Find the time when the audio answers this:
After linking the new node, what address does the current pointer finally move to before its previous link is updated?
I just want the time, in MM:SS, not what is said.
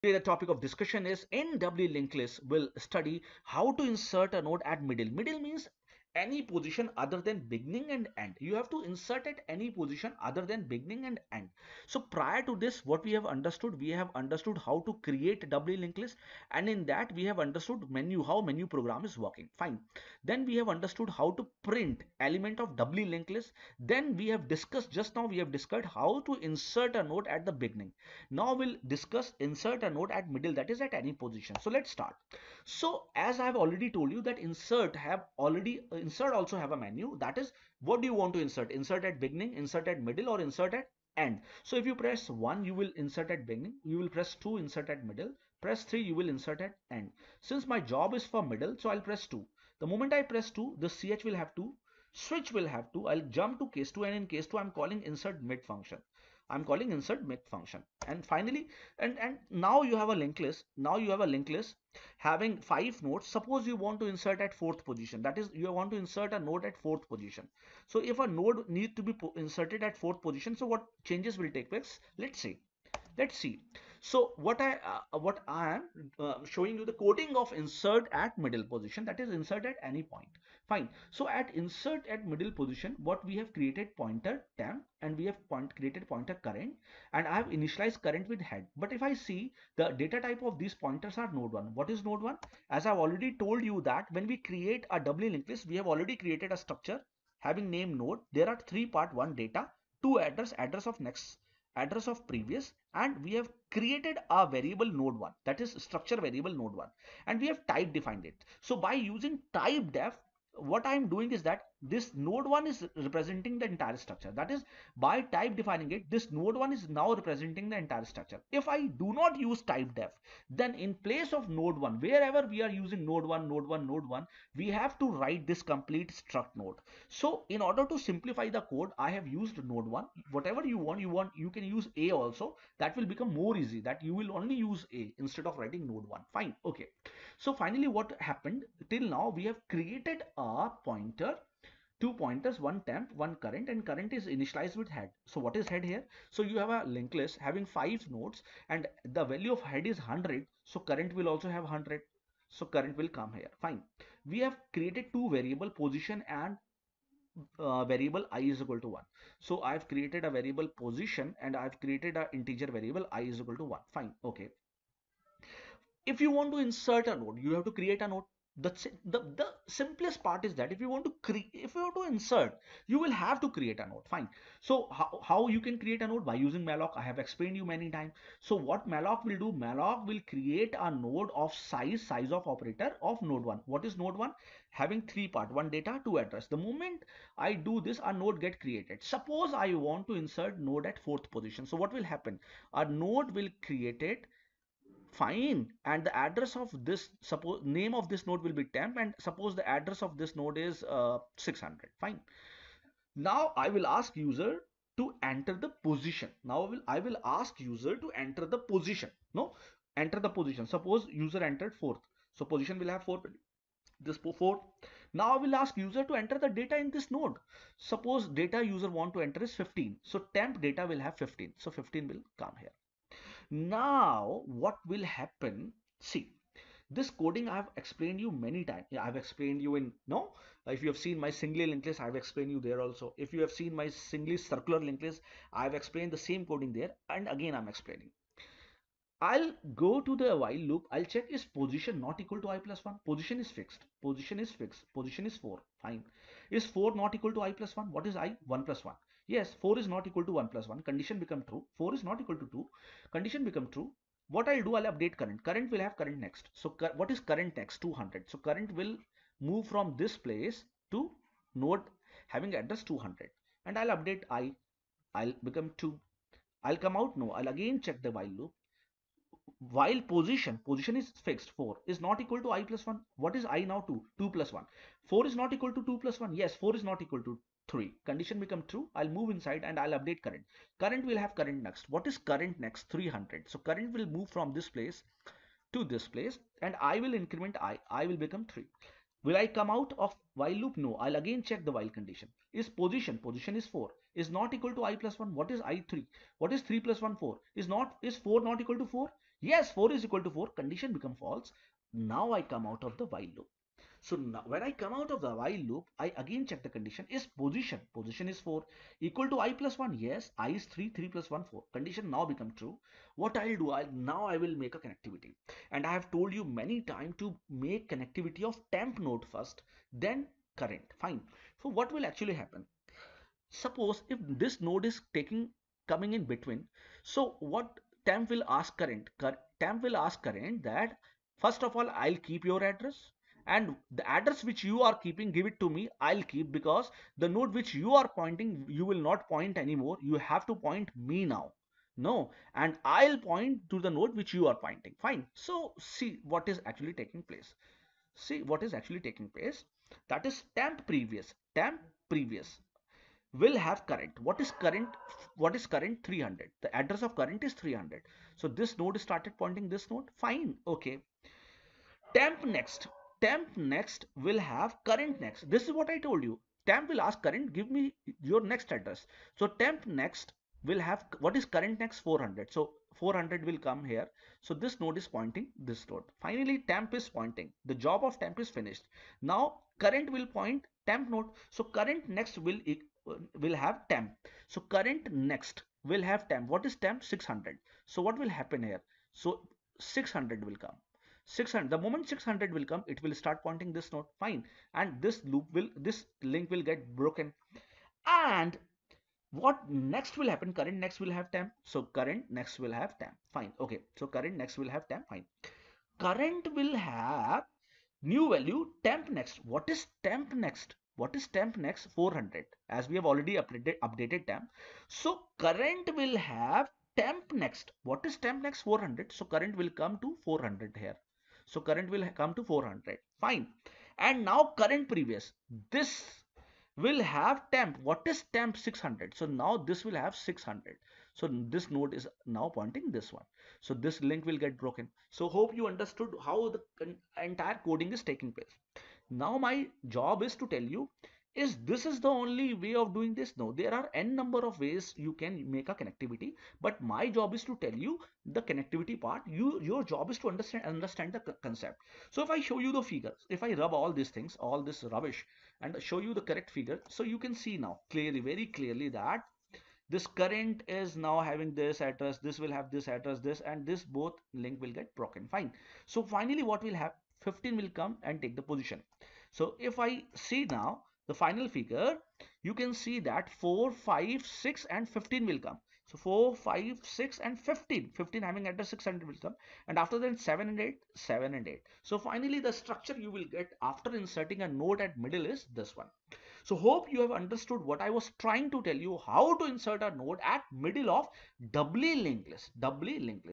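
06:59.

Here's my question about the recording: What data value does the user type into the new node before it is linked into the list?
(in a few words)
15.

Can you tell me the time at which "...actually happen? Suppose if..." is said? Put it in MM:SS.
05:22.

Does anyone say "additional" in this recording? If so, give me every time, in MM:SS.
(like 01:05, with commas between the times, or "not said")
not said.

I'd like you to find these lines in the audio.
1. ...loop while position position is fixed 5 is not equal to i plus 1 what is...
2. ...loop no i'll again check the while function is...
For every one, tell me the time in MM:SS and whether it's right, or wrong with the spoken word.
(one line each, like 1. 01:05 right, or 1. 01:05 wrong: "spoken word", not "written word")
1. 04:28 wrong: "4", not "5"
2. 04:50 wrong: "condition", not "function".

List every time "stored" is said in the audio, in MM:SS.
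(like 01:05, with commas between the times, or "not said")
not said.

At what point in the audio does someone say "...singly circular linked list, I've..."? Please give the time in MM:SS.
03:53.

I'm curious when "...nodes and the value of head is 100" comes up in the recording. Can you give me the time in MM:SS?
02:28.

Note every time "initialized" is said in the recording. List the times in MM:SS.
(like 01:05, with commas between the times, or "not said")
01:27, 02:24.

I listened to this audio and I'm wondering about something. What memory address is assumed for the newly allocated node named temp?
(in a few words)
600.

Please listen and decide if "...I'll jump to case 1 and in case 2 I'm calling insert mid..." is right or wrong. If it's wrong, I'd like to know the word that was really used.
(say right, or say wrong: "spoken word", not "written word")
wrong: "2", not "1".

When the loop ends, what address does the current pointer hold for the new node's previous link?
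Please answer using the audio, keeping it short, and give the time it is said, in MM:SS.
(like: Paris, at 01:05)
300, at 05:56.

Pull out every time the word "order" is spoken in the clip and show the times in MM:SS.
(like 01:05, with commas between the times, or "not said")
02:07.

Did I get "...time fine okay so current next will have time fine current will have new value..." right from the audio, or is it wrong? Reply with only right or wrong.
right.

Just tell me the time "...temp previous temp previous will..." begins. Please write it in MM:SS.
05:50.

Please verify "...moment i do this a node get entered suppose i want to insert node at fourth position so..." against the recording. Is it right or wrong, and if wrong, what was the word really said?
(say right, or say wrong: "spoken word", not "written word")
wrong: "created", not "entered".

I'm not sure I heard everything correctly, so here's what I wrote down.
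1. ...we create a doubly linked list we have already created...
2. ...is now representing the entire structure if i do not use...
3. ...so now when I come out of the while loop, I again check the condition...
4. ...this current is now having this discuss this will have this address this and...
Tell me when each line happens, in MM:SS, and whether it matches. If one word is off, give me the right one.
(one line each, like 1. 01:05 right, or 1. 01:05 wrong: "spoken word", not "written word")
1. 01:34 right
2. 01:56 right
3. 05:04 right
4. 07:39 wrong: "address", not "discuss".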